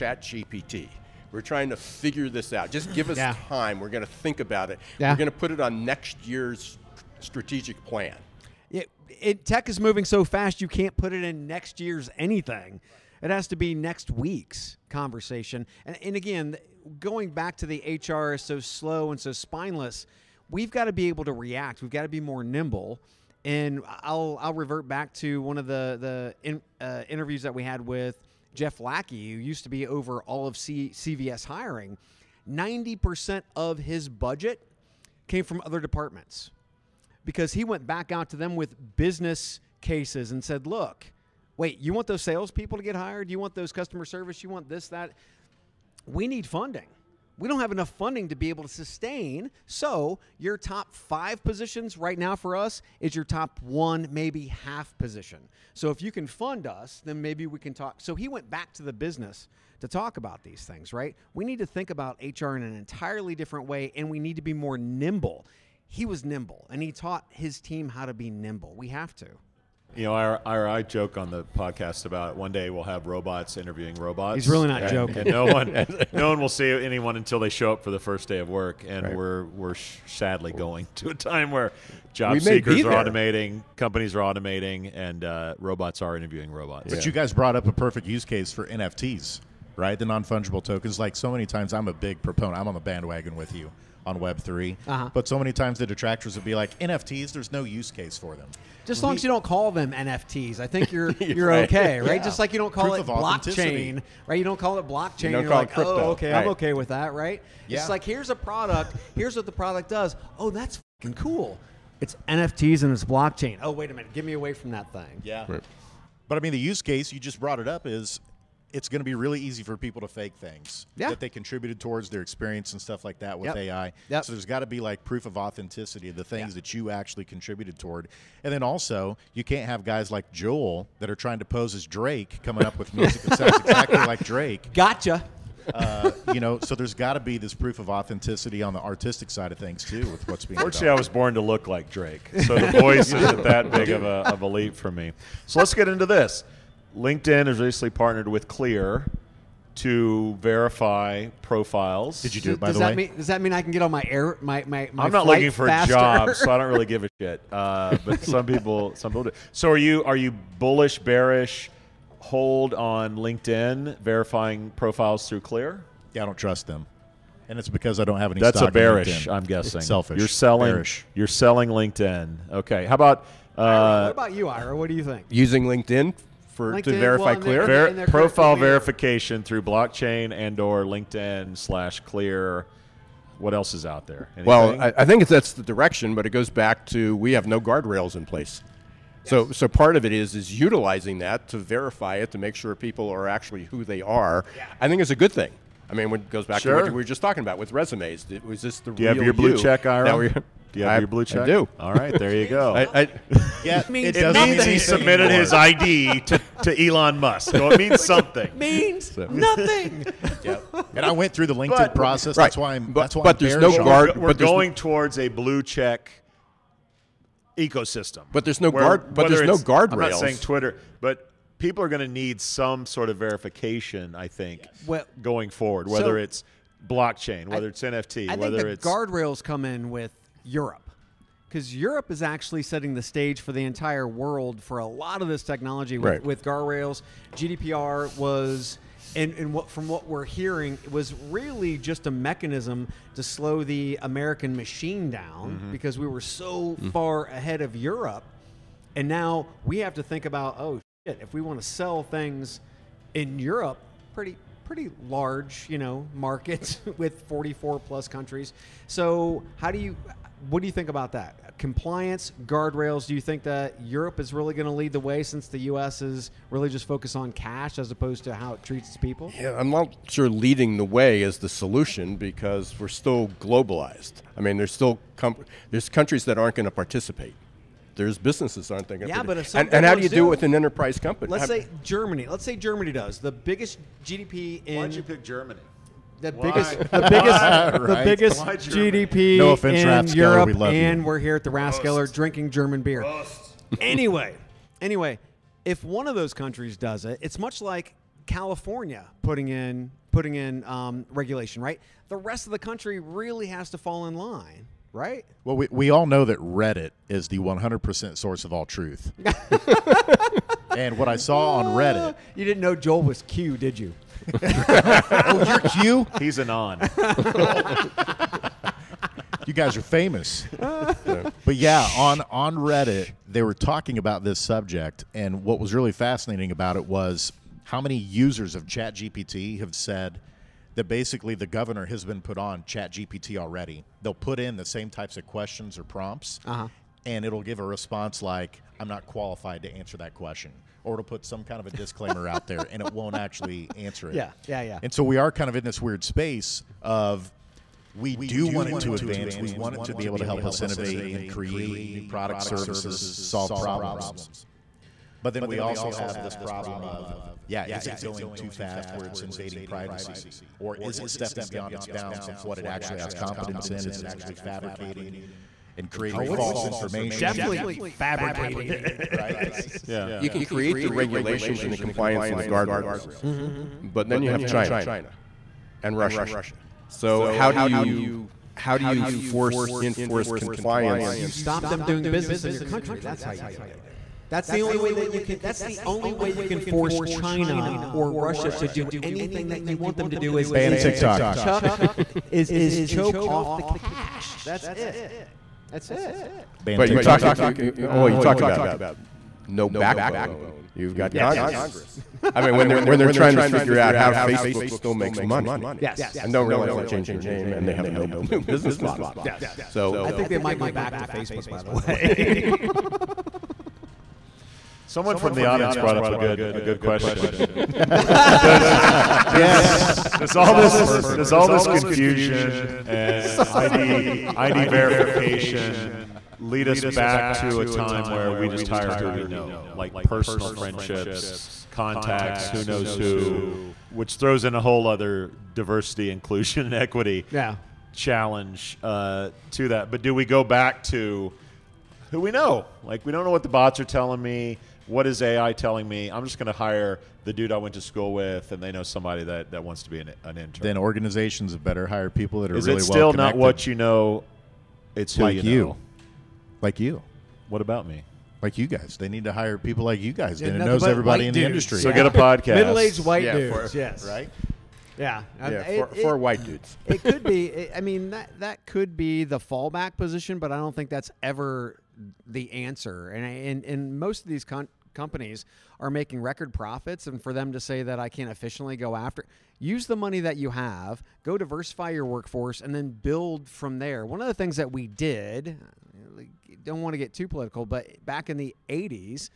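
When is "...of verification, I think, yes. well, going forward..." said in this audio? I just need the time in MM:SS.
03:43.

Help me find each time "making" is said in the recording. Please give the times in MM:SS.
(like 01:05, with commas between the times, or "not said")
07:55.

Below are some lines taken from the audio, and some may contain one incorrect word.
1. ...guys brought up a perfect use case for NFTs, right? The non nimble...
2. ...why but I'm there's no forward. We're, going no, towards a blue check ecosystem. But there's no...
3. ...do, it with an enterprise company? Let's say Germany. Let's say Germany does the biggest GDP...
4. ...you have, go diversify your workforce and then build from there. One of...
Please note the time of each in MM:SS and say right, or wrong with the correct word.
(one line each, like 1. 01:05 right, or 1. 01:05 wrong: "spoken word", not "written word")
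1. 01:27 wrong: "fungible", not "nimble"
2. 03:33 wrong: "guard", not "forward"
3. 04:40 right
4. 08:00 right.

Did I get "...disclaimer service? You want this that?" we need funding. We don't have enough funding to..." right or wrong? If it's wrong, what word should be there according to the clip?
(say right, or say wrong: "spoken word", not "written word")
wrong: "customer", not "disclaimer".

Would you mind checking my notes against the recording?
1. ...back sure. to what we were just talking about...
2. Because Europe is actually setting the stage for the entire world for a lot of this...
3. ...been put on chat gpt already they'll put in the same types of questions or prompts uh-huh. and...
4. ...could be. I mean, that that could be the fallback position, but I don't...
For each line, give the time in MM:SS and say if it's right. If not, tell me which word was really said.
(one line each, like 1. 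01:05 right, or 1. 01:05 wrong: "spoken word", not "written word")
1. 03:16 right
2. 03:51 right
3. 05:32 right
4. 07:47 right.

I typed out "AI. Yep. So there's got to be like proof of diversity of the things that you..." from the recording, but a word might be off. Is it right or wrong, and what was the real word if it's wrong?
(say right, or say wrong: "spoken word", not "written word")
wrong: "authenticity", not "diversity".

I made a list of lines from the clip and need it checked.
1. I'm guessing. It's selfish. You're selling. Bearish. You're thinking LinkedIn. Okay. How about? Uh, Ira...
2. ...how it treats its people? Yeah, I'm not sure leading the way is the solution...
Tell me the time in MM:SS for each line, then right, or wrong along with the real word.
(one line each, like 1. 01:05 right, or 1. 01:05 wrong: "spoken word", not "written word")
1. 02:49 wrong: "selling", not "thinking"
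2. 04:28 right.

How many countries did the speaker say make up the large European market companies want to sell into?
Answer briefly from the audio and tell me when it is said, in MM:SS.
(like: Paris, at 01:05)
44 plus, at 04:17.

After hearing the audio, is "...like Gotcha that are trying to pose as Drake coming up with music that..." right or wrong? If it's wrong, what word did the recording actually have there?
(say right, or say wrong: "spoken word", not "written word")
wrong: "Joel", not "Gotcha".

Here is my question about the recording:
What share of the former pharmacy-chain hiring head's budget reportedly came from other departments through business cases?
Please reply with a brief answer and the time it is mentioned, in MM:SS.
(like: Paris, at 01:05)
90%, at 00:32.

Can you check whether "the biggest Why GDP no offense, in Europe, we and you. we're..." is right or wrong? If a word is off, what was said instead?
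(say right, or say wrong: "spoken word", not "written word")
right.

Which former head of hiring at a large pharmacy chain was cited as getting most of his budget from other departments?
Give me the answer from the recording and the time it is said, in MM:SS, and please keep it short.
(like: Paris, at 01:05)
Jeff Lackey, at 00:28.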